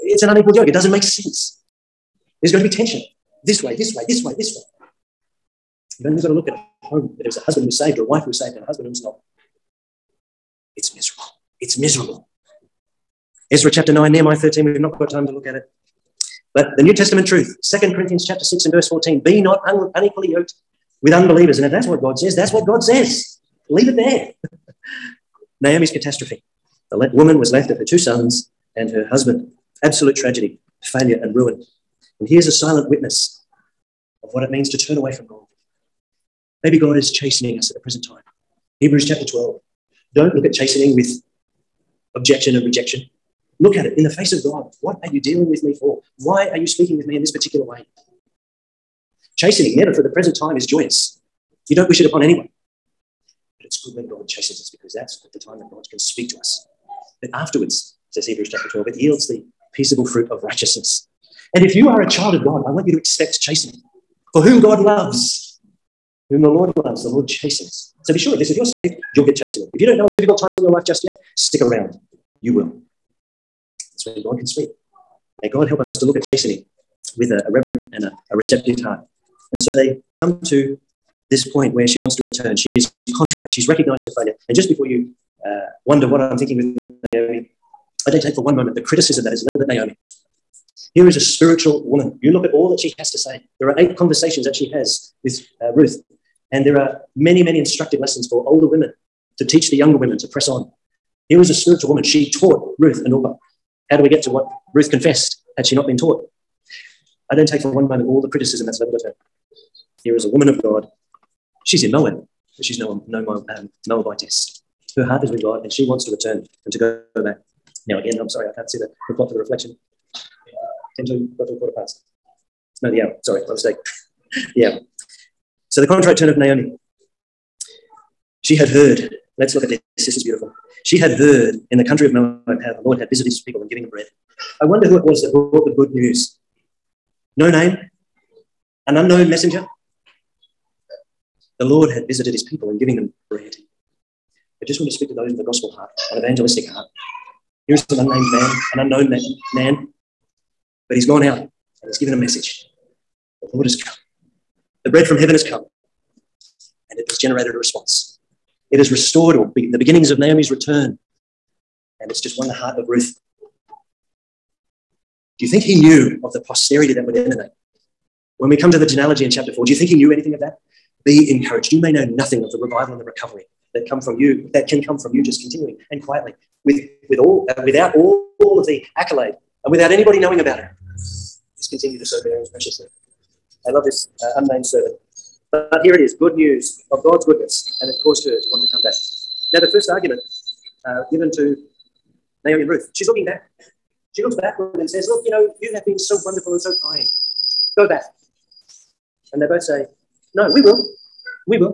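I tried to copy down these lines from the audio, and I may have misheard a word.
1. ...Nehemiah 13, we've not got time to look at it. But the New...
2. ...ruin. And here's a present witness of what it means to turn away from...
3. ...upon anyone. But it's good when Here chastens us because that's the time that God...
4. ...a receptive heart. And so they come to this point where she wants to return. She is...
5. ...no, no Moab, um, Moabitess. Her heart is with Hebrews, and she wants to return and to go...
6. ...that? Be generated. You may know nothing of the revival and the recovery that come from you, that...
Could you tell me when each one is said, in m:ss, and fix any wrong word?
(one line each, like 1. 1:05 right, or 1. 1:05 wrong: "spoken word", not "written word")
1. 0:14 right
2. 0:31 wrong: "silent", not "present"
3. 0:52 wrong: "God", not "Here"
4. 1:18 right
5. 1:52 wrong: "God", not "Hebrews"
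6. 2:50 wrong: "encouraged", not "generated".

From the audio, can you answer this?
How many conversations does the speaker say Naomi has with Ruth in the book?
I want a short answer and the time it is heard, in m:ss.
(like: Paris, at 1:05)
8, at 1:33.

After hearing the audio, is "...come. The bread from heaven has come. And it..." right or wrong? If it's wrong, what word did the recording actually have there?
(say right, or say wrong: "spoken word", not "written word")
right.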